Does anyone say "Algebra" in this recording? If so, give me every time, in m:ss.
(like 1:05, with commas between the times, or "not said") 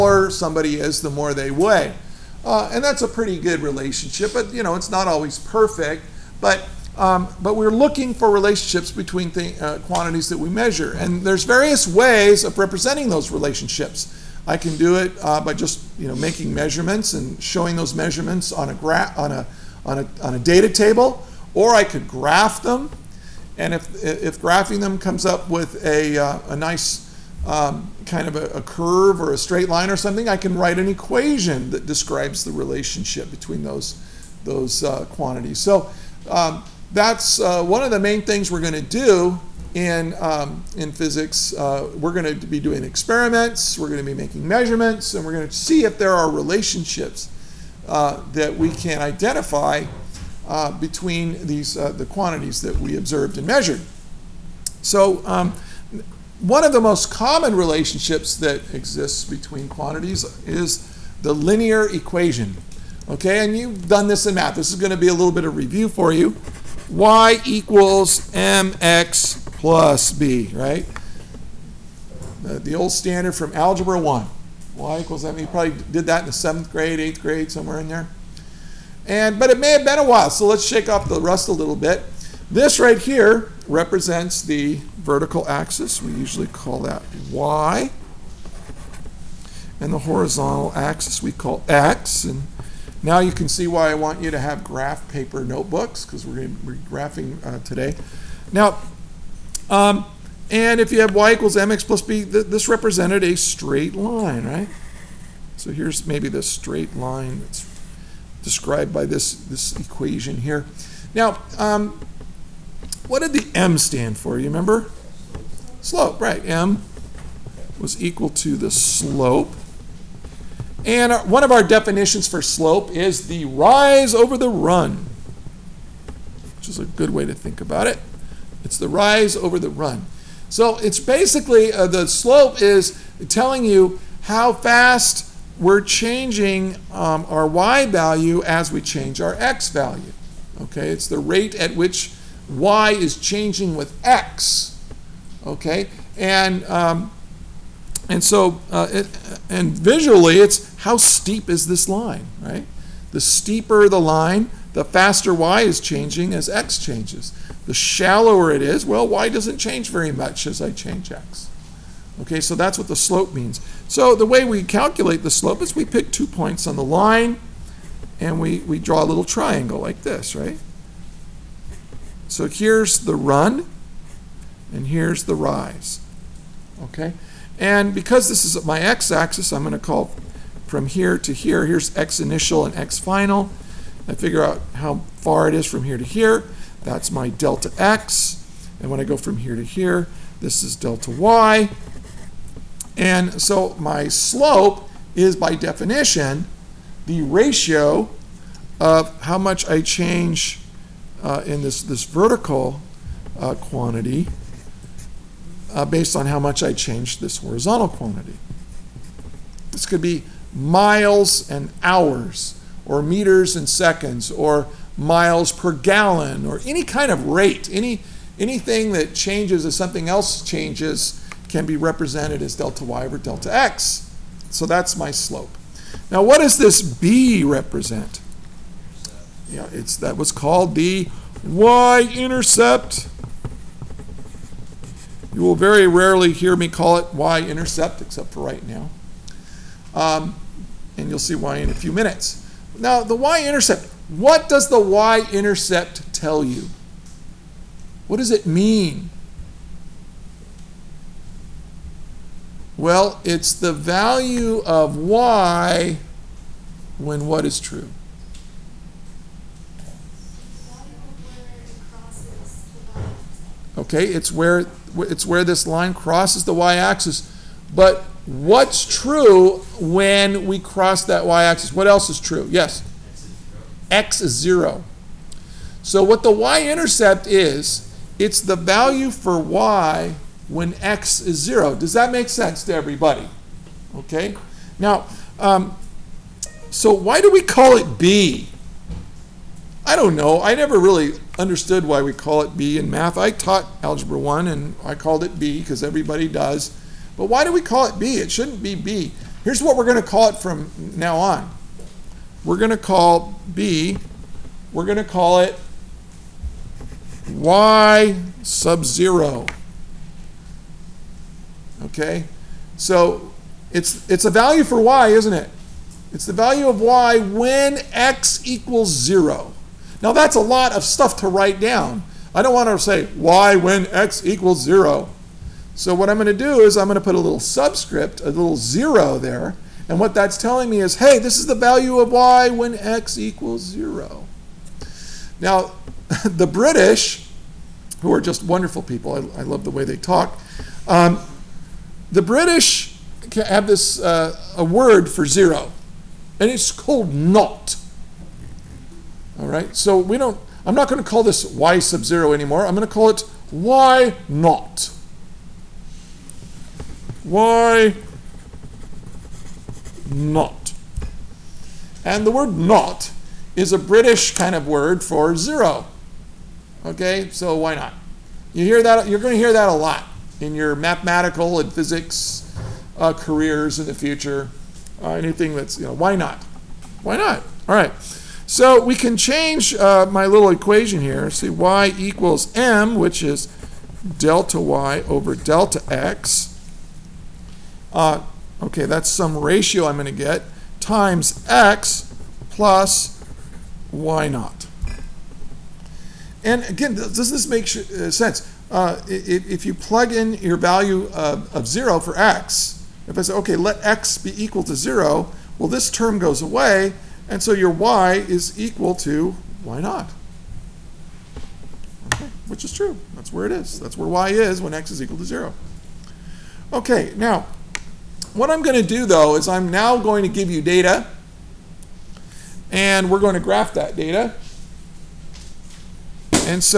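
1:13, 4:53.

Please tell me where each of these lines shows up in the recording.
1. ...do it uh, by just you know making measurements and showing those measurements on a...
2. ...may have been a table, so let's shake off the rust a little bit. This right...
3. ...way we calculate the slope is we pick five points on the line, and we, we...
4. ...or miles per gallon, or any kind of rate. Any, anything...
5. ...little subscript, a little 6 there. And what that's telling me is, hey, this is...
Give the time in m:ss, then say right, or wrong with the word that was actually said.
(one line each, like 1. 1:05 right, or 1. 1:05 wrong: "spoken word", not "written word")
1. 0:14 right
2. 1:19 wrong: "while", not "table"
3. 2:44 wrong: "two", not "five"
4. 3:34 right
5. 5:27 wrong: "0", not "6".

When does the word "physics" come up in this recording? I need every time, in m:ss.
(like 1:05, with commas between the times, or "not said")
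0:40, 6:11.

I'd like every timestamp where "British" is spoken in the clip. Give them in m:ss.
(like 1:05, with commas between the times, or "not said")
5:36, 5:42, 6:03.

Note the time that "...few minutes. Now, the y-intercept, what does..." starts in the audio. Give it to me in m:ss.
4:01.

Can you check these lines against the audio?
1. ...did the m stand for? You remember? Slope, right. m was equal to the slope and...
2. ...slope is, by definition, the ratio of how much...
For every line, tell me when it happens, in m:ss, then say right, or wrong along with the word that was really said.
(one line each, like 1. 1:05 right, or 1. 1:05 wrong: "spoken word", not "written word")
1. 1:53 right
2. 3:14 right.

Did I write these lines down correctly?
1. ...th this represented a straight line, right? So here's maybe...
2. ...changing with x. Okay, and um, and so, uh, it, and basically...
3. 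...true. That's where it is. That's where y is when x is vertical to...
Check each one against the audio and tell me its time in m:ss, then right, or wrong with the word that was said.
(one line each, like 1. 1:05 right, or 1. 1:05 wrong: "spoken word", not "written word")
1. 1:42 right
2. 2:23 wrong: "visually", not "basically"
3. 6:52 wrong: "equal", not "vertical".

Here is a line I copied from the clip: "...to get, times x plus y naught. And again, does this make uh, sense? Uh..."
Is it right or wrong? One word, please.
right.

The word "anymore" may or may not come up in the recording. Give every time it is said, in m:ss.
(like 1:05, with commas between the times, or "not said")
5:52.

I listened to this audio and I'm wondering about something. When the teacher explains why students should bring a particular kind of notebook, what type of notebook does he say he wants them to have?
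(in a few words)
graph paper notebooks.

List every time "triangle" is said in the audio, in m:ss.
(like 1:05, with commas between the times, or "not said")
2:49.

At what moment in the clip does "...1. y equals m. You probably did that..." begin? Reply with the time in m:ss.
1:13.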